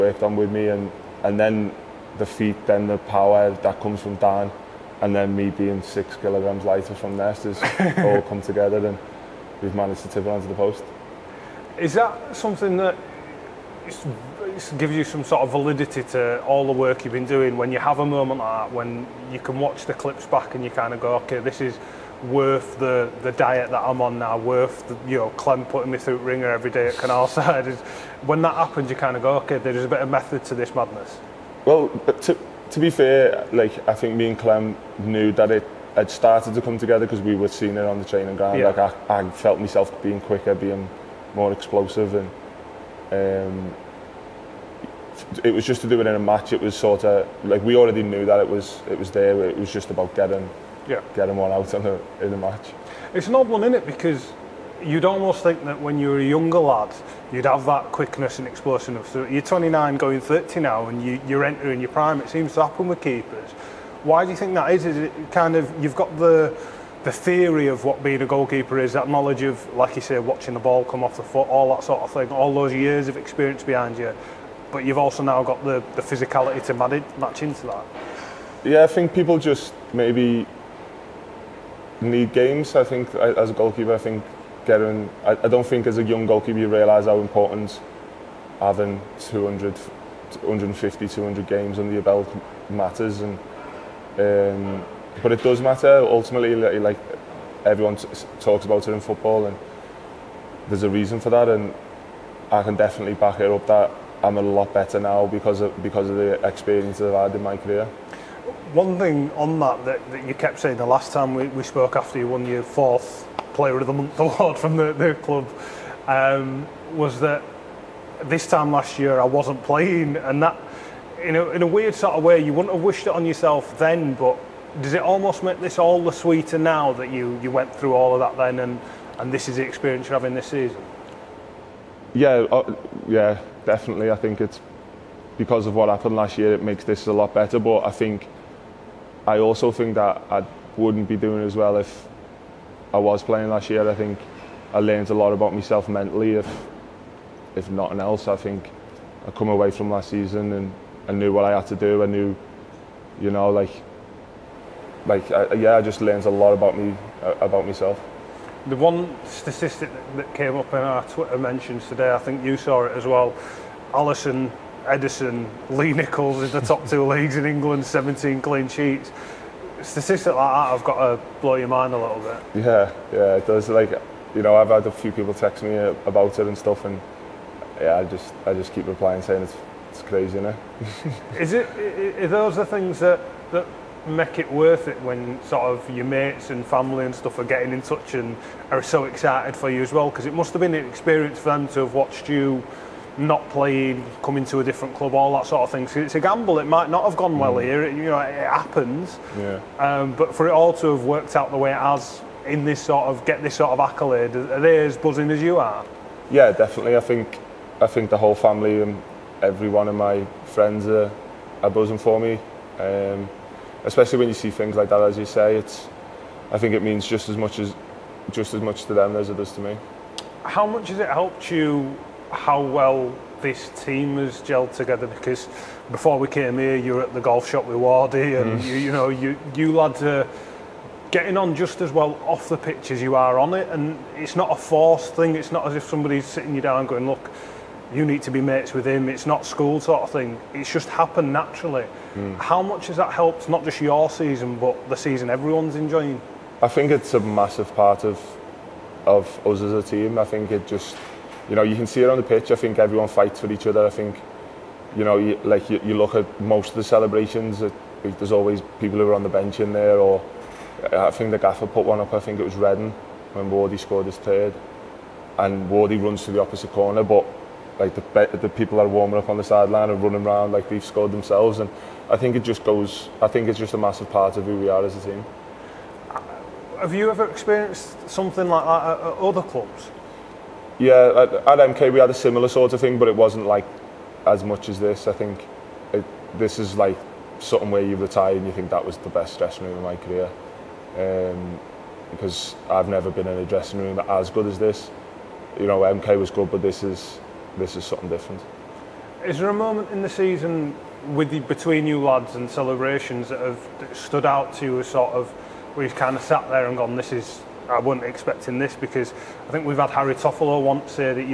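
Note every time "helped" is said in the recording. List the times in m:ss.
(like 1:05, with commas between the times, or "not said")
3:41, 4:03.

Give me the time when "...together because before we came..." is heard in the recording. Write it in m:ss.
3:44.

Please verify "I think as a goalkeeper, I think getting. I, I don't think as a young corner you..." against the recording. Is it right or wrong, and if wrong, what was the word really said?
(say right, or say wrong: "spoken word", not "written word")
wrong: "goalkeeper", not "corner".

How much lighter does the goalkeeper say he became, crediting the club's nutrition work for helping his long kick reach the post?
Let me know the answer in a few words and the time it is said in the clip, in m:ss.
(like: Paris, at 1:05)
6 kilograms, at 0:05.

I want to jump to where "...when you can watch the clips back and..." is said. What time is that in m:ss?
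0:18.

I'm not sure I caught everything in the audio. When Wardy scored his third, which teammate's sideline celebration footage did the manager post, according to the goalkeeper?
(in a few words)
Redden.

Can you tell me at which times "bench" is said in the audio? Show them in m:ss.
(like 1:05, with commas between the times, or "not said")
4:19.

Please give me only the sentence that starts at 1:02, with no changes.
It seems to happen with keepers.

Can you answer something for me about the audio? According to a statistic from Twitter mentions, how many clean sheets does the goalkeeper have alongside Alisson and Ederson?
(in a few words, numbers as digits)
17.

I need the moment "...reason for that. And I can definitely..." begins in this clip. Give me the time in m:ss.
1:40.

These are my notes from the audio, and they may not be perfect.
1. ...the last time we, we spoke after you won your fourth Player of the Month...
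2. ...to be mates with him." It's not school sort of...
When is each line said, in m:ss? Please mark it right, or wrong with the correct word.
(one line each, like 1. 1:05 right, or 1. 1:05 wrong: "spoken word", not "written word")
1. 1:50 right
2. 3:58 right.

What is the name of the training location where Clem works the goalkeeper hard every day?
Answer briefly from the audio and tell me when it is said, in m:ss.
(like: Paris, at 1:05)
Canalside, at 0:26.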